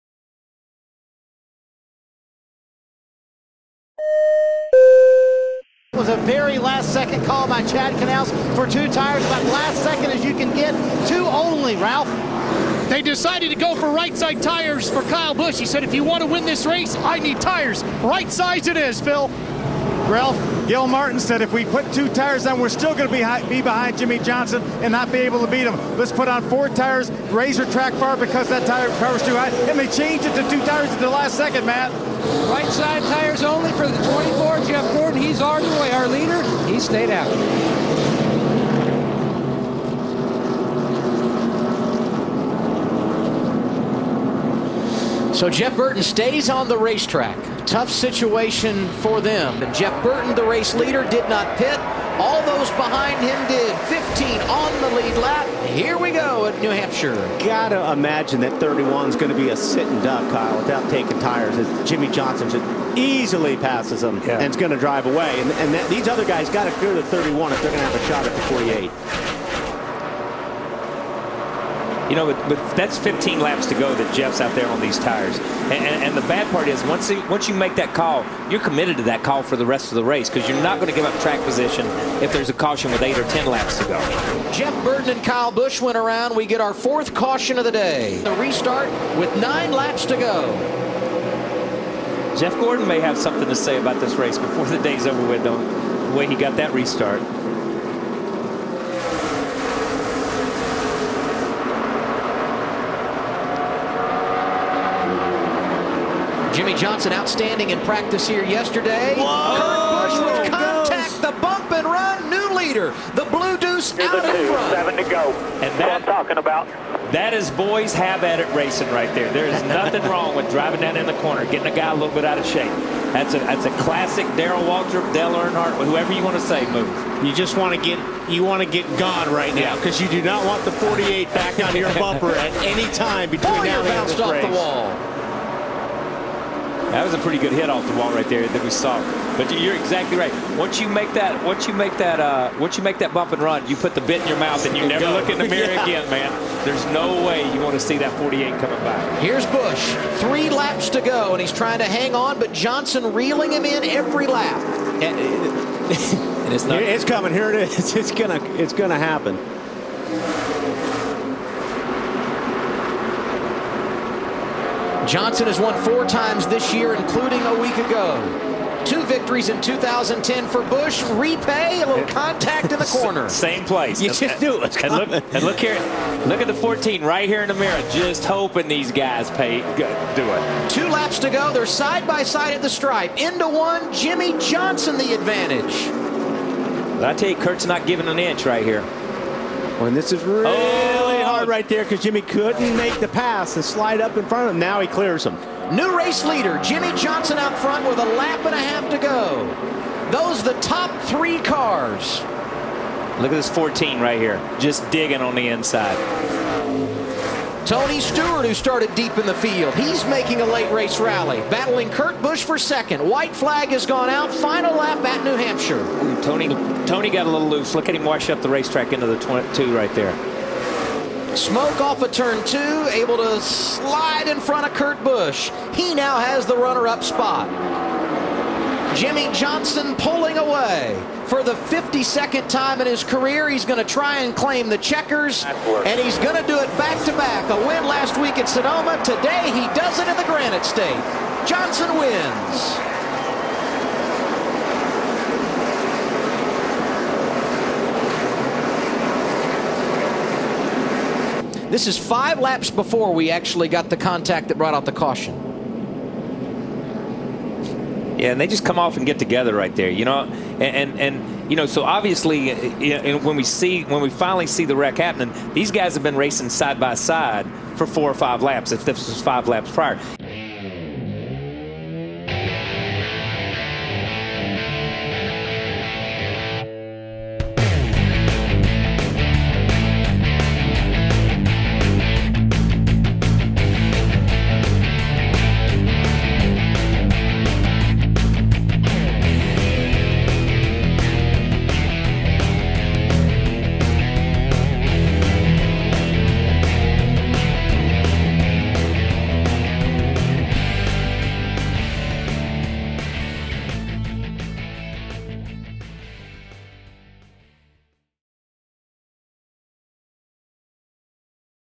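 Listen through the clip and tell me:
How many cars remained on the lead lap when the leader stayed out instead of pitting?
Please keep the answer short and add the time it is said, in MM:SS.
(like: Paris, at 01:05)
15, at 00:53.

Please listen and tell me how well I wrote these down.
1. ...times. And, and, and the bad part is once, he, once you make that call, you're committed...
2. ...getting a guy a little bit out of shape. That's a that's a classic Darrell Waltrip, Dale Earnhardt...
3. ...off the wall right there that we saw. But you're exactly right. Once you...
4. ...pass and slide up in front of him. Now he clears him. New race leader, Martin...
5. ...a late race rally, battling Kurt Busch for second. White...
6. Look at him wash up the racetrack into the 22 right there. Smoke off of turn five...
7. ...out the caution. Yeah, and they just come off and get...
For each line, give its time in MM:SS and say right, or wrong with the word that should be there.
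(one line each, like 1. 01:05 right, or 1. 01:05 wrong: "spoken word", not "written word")
1. 01:14 wrong: "tires", not "times"
2. 02:01 right
3. 02:17 right
4. 03:13 wrong: "Jimmie", not "Martin"
5. 03:30 right
6. 03:37 wrong: "two", not "five"
7. 04:14 right.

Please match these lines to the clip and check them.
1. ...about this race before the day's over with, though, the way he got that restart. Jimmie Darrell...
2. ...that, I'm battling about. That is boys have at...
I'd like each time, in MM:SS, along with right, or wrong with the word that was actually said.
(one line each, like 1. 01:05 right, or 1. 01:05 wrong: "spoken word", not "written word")
1. 01:33 wrong: "Johnson", not "Darrell"
2. 01:55 wrong: "talking", not "battling".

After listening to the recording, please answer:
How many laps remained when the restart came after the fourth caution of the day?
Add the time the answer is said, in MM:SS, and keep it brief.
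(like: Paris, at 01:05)
9, at 01:29.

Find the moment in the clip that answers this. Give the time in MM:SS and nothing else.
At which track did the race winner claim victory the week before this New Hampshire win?
03:58.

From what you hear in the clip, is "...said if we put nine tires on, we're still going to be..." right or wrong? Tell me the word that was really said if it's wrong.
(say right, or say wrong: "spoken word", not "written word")
wrong: "two", not "nine".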